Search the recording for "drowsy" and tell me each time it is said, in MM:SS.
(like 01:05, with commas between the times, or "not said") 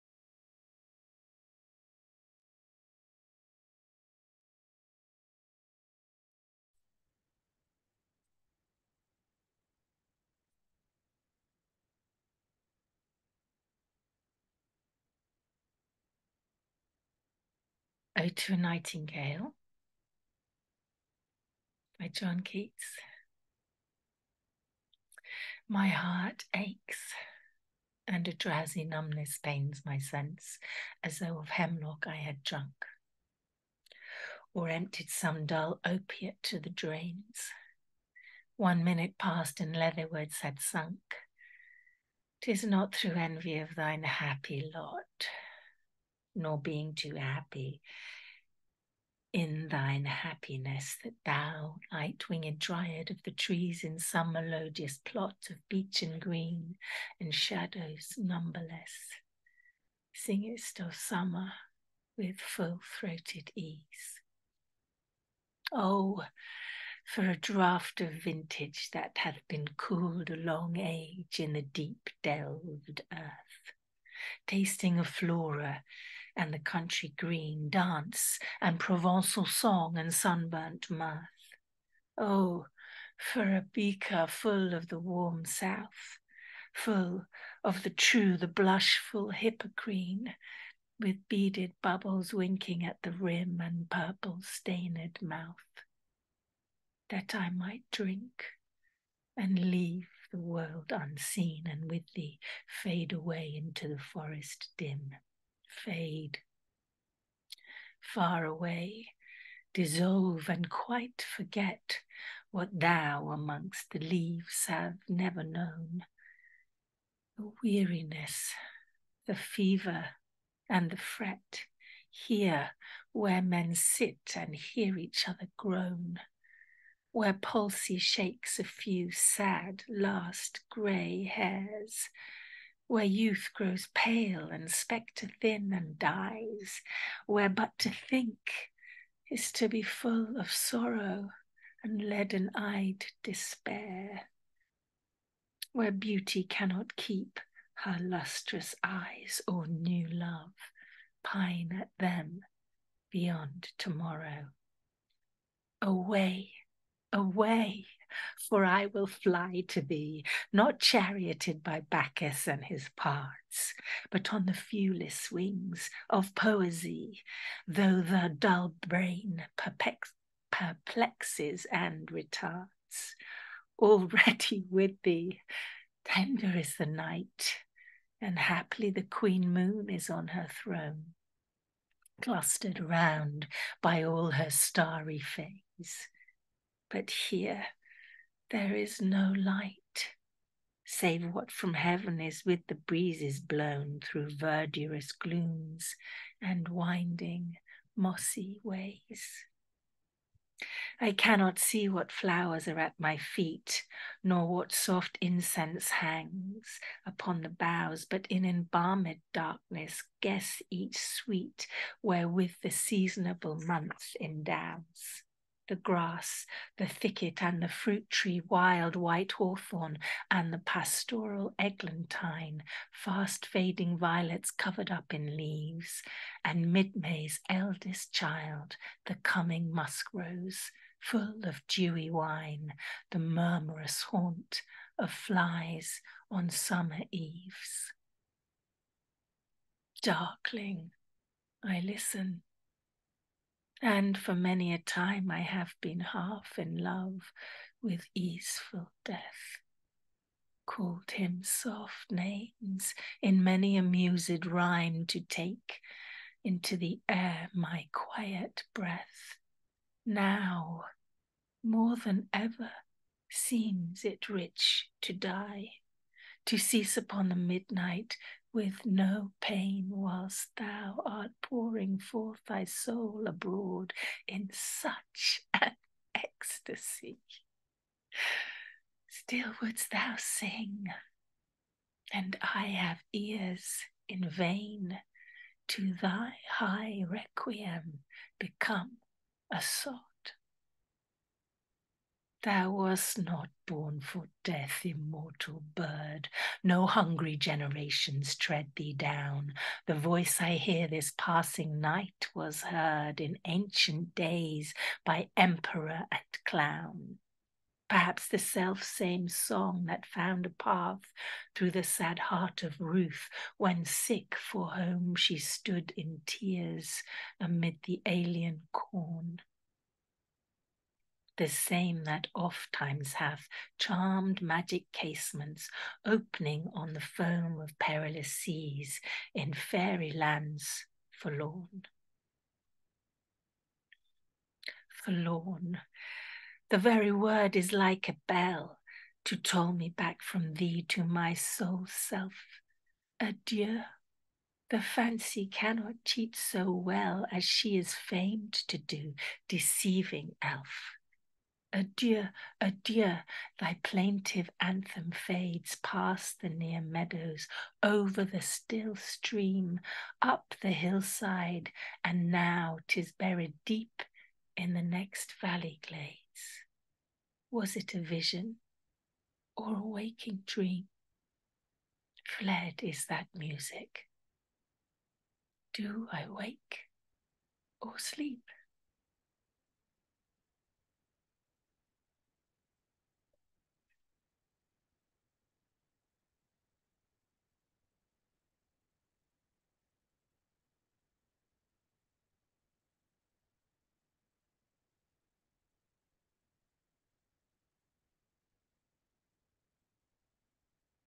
00:28.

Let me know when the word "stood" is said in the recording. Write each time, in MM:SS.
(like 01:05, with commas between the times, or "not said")
05:15.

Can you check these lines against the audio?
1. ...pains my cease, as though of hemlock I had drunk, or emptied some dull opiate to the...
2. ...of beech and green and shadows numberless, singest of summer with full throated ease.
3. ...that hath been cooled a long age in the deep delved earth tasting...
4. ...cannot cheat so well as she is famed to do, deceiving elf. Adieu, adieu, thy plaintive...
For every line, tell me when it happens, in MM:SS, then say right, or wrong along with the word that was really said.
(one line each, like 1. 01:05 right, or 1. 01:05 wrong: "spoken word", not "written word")
1. 00:29 wrong: "sense", not "cease"
2. 00:55 right
3. 01:08 right
4. 05:45 right.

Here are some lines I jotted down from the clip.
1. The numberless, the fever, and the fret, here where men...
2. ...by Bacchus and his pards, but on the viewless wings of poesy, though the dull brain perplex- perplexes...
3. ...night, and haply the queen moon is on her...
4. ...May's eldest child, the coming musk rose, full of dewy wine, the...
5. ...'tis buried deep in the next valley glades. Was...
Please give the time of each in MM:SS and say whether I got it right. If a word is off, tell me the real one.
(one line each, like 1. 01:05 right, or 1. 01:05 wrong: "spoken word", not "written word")
1. 01:57 wrong: "weariness", not "numberless"
2. 02:41 right
3. 02:56 right
4. 03:46 right
5. 06:02 right.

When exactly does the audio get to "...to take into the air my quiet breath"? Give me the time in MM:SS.
04:15.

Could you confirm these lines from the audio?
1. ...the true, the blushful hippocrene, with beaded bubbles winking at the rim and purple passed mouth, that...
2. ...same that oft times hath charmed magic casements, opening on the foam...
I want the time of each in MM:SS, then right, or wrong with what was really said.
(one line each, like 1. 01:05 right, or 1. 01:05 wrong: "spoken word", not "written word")
1. 01:27 wrong: "stained", not "passed"
2. 05:21 right.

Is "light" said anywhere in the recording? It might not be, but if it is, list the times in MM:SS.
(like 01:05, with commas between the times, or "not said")
00:51, 03:09.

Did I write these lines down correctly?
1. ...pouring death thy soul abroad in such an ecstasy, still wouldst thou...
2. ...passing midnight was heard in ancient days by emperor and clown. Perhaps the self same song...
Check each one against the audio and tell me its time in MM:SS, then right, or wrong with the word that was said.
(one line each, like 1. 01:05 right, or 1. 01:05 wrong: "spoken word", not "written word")
1. 04:31 wrong: "forth", not "death"
2. 05:01 wrong: "night", not "midnight".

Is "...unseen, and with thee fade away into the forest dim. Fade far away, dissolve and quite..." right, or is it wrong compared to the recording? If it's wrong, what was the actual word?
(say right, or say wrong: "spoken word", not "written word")
right.